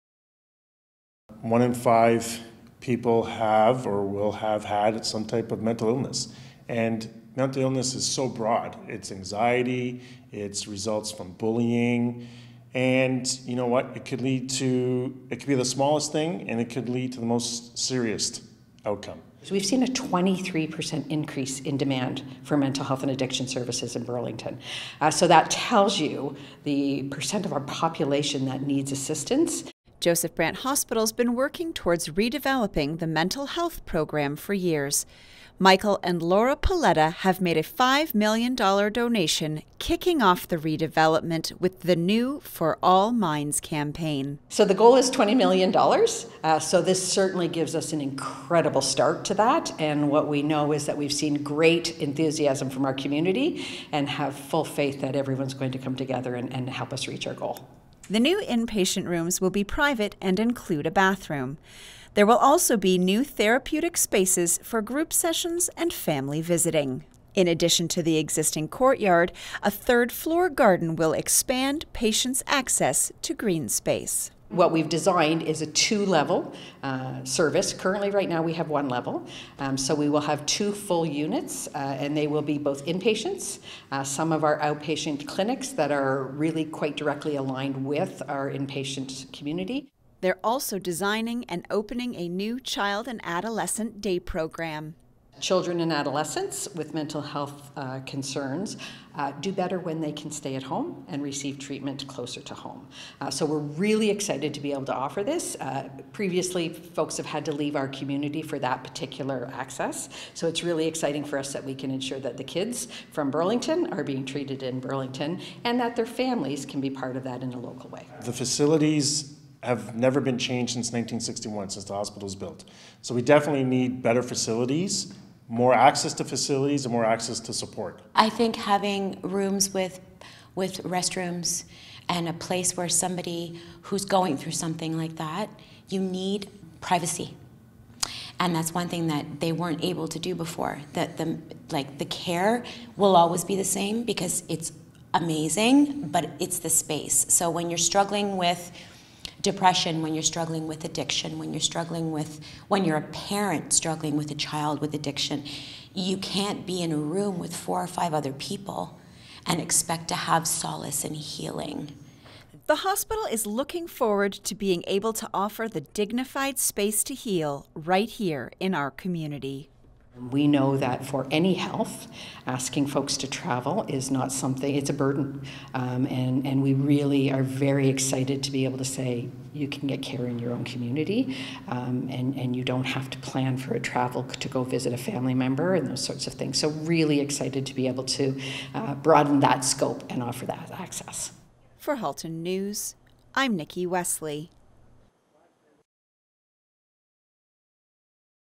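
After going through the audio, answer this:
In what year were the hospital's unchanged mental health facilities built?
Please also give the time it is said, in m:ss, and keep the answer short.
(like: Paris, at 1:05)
1961, at 2:00.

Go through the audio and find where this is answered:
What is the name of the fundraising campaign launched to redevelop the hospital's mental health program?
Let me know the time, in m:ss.
0:42.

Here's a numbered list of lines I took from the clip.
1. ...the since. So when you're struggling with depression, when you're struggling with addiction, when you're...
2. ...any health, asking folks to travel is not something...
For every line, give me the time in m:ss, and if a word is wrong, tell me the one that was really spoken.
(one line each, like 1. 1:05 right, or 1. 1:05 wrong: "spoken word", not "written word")
1. 2:26 wrong: "space", not "since"
2. 2:51 right.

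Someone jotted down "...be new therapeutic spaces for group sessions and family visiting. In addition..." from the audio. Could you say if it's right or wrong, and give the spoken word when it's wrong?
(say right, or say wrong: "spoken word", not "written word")
right.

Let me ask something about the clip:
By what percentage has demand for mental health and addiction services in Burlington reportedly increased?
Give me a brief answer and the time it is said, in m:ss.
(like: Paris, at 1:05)
23%, at 0:19.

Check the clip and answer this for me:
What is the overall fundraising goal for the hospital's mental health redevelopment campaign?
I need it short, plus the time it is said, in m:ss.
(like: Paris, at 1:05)
$20 million, at 0:45.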